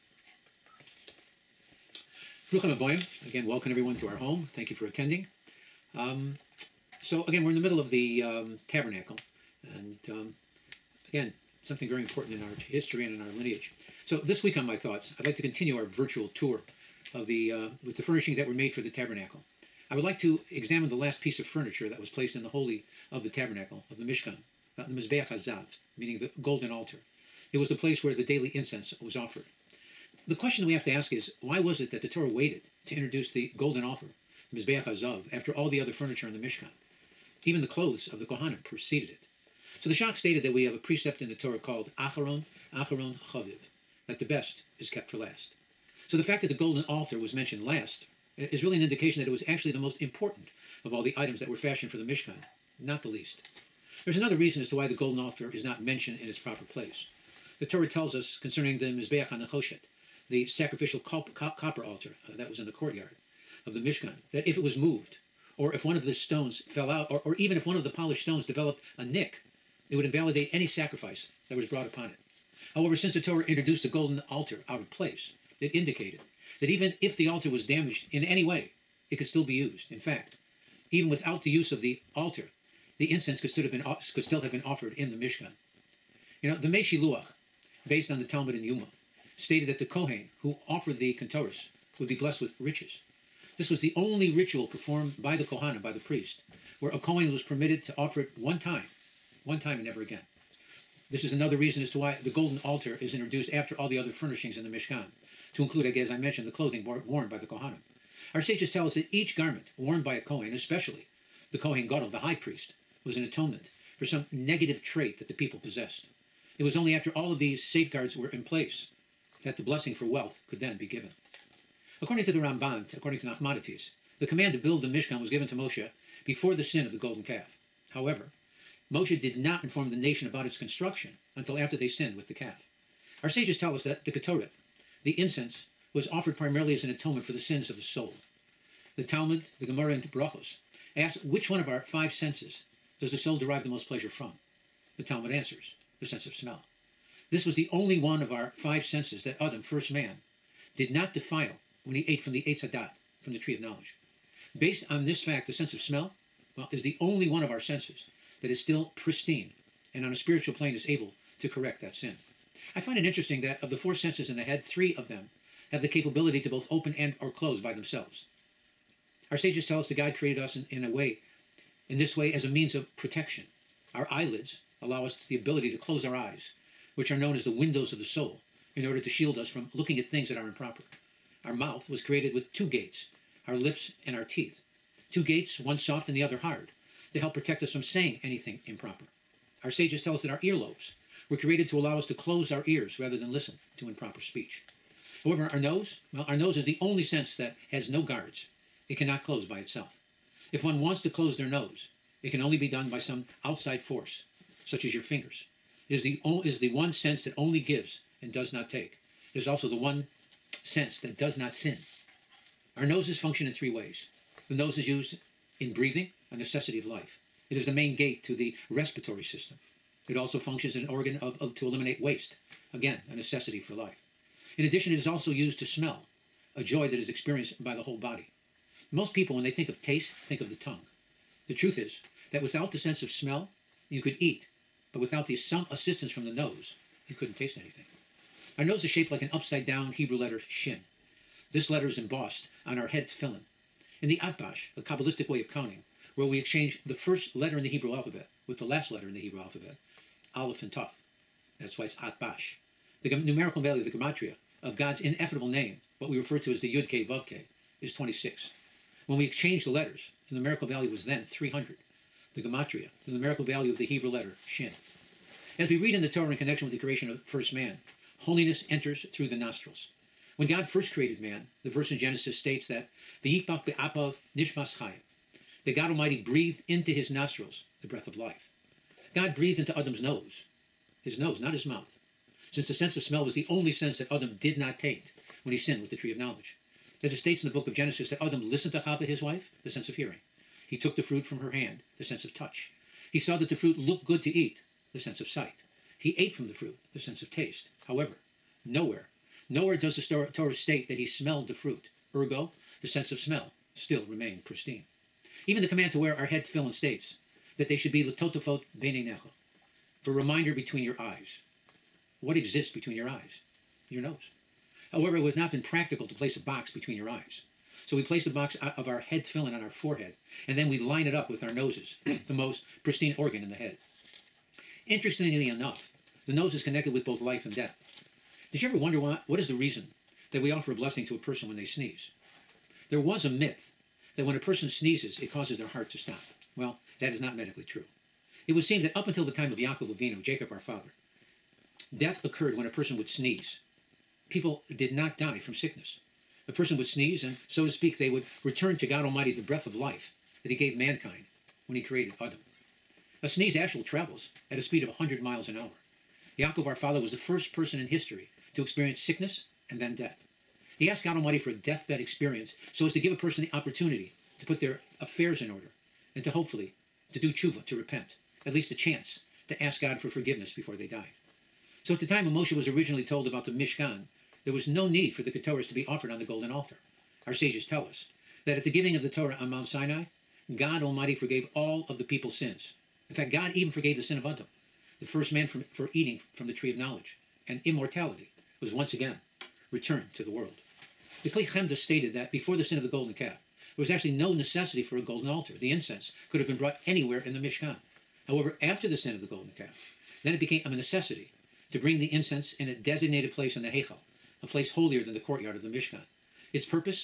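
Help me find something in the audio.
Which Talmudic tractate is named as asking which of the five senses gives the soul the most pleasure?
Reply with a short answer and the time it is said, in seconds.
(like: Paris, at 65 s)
Brachos, at 140 s.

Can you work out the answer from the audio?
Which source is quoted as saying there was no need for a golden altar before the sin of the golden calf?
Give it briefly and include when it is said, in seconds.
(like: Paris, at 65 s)
The Kli Chemda, at 391 s.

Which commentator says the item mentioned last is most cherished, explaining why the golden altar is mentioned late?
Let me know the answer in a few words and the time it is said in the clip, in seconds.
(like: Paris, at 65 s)
The Shach, at 39 s.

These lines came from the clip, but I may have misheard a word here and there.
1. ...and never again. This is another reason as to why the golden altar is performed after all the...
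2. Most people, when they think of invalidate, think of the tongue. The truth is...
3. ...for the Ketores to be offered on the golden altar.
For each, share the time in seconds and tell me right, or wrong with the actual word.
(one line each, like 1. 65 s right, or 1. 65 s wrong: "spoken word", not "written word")
1. 99 s wrong: "introduced", not "performed"
2. 228 s wrong: "taste", not "invalidate"
3. 375 s right.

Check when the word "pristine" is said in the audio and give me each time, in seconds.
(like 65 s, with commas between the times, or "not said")
158 s, 304 s, 322 s.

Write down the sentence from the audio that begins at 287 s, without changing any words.
As it states in the book of Genesis that Adam listened to Hava, his wife, the sense of hearing.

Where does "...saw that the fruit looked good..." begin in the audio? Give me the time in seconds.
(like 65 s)
293 s.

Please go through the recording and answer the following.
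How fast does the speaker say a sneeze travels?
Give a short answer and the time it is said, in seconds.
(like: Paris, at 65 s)
100 miles an hour, at 354 s.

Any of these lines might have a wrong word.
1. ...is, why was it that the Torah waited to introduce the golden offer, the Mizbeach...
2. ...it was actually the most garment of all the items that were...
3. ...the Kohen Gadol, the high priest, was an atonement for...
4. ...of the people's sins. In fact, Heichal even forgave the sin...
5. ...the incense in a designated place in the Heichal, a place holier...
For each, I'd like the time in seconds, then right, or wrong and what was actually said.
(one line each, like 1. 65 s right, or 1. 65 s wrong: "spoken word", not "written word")
1. 31 s right
2. 49 s wrong: "important", not "garment"
3. 111 s right
4. 381 s wrong: "God", not "Heichal"
5. 401 s right.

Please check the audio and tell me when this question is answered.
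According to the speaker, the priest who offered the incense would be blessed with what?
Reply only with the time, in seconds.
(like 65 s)
92 s.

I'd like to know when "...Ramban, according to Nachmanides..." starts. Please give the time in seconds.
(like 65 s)
122 s.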